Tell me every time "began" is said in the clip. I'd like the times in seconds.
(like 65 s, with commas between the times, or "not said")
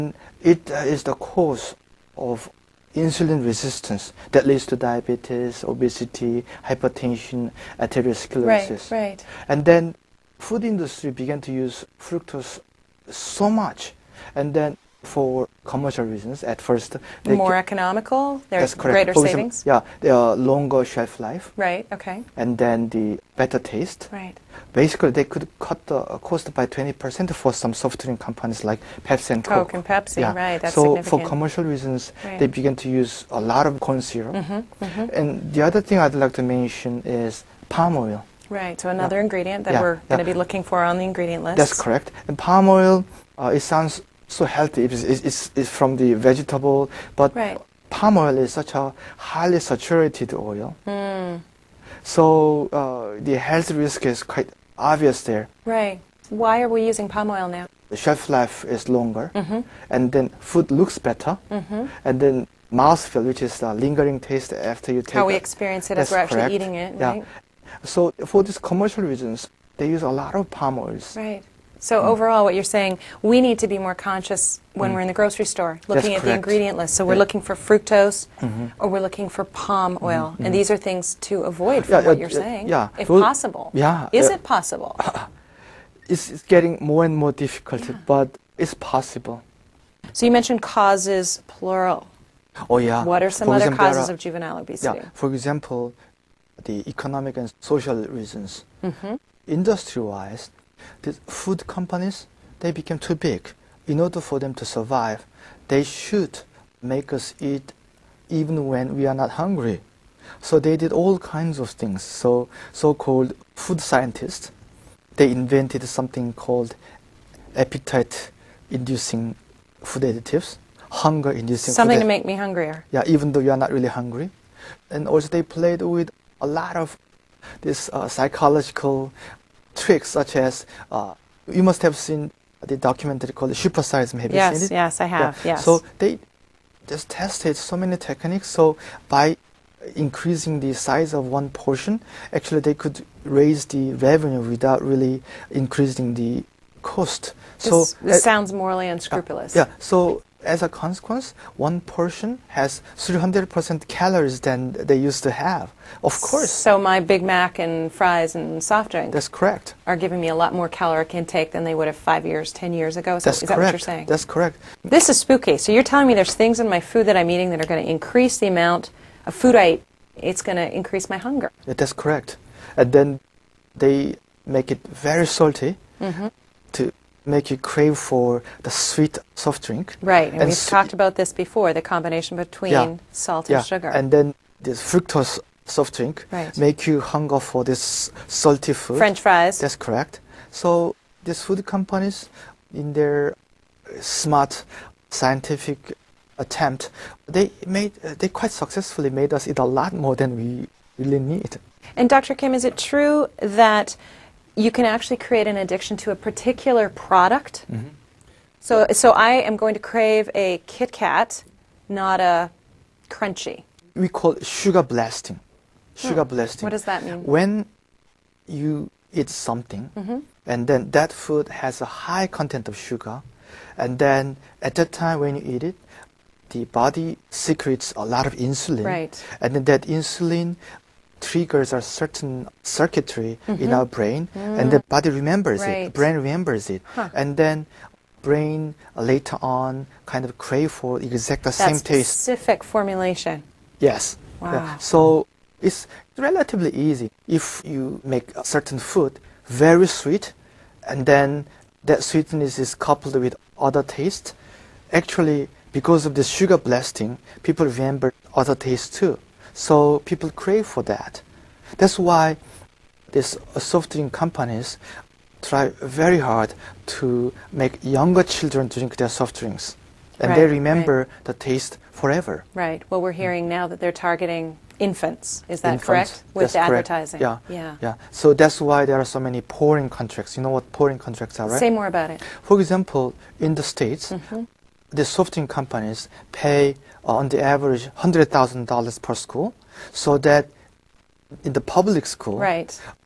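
11 s, 32 s.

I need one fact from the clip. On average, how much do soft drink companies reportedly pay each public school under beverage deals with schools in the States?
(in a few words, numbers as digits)
$100,000.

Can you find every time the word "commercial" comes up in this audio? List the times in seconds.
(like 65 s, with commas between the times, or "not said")
15 s, 31 s, 68 s.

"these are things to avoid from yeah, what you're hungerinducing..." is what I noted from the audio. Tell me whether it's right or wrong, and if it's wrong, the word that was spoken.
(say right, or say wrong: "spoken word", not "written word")
wrong: "saying", not "hungerinducing".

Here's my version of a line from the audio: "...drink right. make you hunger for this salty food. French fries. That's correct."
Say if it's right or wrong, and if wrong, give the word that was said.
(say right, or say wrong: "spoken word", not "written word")
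right.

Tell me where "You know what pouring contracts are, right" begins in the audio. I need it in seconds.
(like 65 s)
280 s.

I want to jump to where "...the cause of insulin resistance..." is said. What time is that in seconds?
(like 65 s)
1 s.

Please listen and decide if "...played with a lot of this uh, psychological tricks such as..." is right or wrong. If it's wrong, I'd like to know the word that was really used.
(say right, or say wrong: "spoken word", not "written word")
right.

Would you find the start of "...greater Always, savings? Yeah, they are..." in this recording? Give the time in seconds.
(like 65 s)
18 s.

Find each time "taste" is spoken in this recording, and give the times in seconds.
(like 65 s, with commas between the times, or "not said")
23 s, 64 s, 241 s, 253 s, 258 s, 271 s.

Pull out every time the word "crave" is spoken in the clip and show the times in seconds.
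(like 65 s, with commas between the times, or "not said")
177 s, 209 s, 240 s, 260 s.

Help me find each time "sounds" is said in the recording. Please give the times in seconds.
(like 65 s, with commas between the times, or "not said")
43 s, 148 s.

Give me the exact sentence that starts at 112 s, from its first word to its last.
So so-called food scientists, they invented something called appetite-inducing food additives, hunger-inducing.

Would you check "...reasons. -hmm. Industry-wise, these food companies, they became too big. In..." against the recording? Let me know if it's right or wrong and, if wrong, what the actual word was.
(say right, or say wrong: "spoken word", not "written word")
right.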